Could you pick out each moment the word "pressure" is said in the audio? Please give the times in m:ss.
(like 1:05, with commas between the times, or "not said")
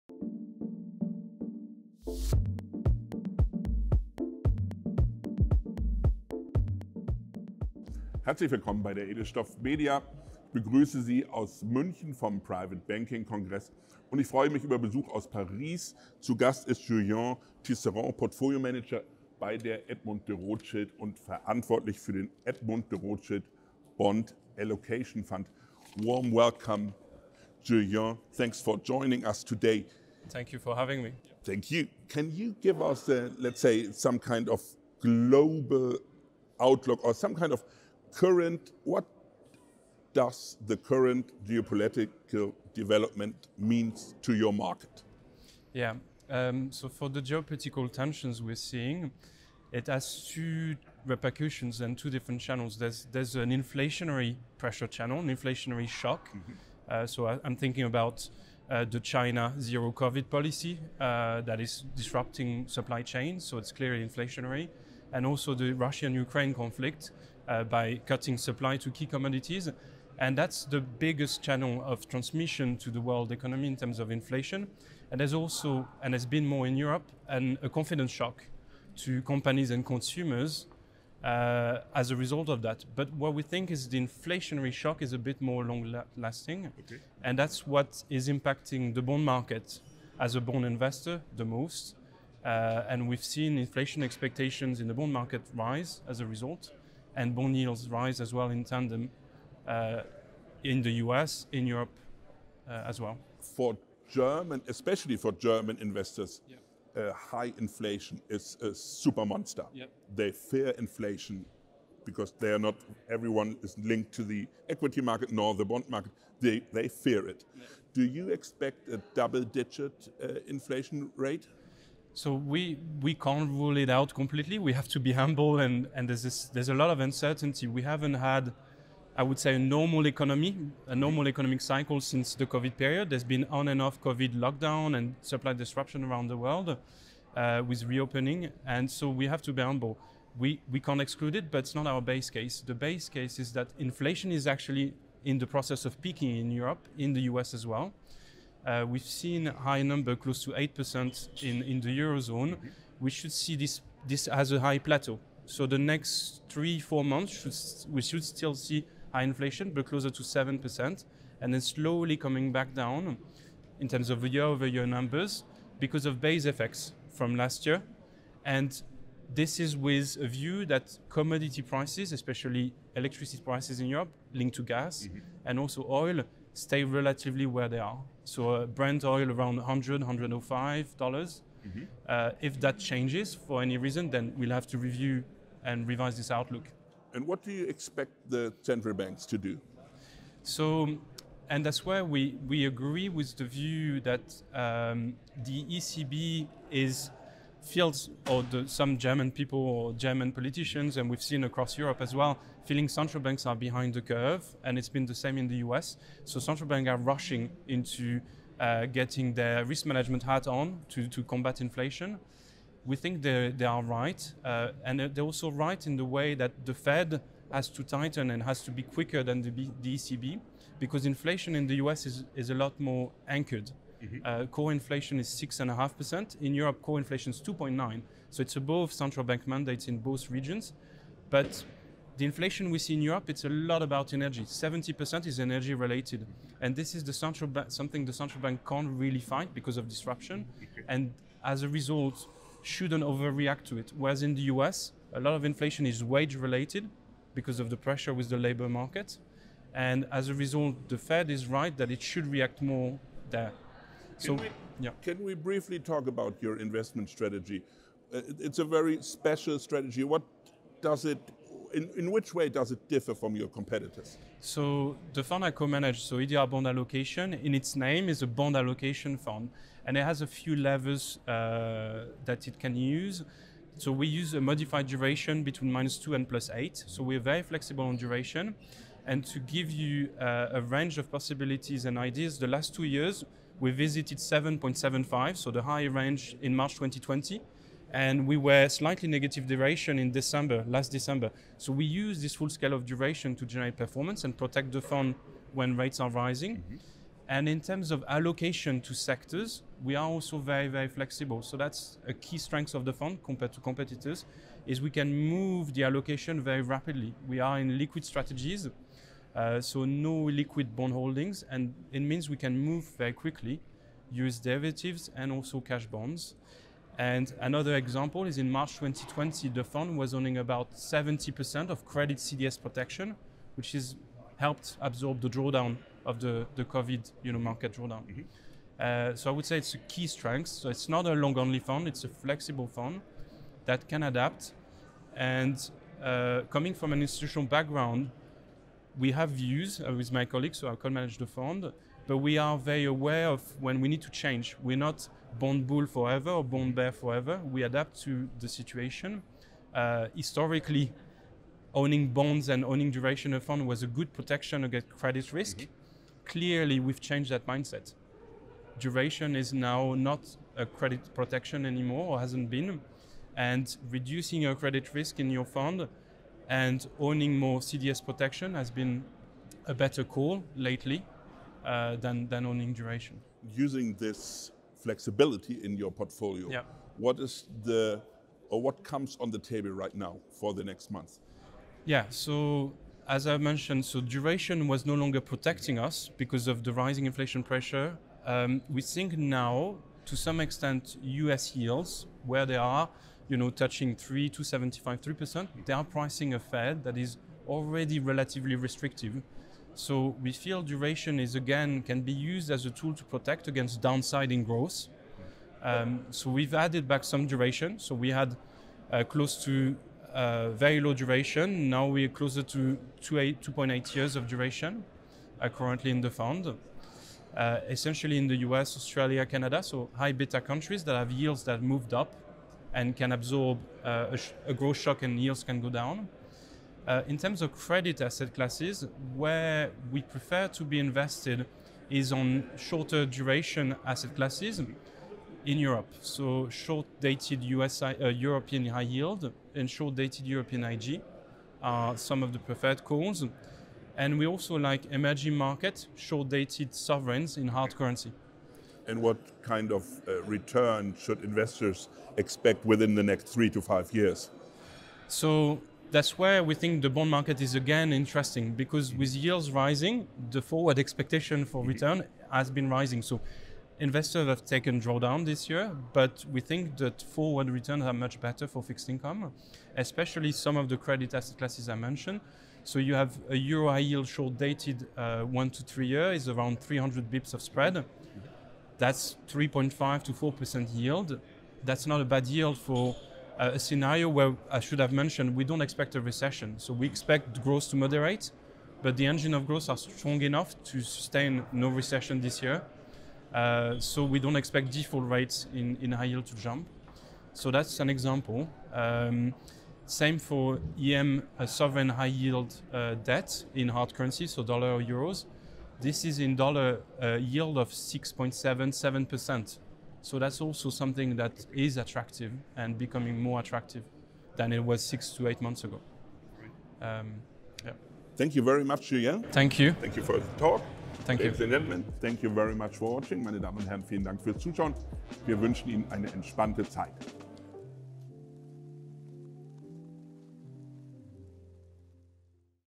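0:54, 4:07, 6:27.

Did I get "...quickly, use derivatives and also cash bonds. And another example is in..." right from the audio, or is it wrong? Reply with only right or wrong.
right.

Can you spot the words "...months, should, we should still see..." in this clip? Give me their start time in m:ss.
2:37.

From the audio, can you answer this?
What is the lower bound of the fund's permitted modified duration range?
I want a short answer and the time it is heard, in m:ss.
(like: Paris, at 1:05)
-2, at 4:35.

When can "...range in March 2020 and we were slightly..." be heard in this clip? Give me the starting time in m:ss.
4:45.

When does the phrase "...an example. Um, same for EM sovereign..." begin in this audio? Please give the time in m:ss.
8:17.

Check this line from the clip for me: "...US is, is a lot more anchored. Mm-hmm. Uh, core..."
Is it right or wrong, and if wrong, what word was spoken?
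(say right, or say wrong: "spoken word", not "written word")
right.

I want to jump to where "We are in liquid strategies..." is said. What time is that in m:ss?
5:07.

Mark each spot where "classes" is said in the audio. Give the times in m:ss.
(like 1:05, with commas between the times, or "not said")
7:08, 7:14, 7:51.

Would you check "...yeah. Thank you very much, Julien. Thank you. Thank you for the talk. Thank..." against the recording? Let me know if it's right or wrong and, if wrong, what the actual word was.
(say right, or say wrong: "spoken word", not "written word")
right.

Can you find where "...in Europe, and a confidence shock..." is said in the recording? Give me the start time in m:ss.
1:16.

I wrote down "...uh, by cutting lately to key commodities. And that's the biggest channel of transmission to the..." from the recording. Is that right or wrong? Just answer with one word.
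wrong.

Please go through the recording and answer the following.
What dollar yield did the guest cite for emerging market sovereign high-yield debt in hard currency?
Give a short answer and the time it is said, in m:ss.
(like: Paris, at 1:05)
6.77%, at 8:27.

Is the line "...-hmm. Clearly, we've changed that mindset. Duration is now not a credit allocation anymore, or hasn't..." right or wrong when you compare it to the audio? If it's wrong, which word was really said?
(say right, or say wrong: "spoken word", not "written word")
wrong: "protection", not "allocation".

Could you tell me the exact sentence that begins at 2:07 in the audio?
We haven't had, I would say, a normal economy, a normal economic cycle since the COVID period.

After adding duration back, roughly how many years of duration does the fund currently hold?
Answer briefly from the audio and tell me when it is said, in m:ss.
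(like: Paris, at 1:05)
2.8 years, at 6:53.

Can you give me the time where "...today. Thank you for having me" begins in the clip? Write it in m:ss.
0:29.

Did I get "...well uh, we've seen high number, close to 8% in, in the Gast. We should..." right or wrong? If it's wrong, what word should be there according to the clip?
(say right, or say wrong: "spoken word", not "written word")
wrong: "Eurozone", not "Gast".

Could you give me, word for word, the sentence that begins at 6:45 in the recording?
Um, so we've added back some duration.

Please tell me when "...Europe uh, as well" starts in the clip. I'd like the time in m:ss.
1:41.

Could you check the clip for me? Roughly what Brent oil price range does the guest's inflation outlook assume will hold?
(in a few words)
100 to 105 dollars.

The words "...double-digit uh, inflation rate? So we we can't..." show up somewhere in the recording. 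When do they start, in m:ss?
1:59.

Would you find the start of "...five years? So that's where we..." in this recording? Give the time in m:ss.
7:33.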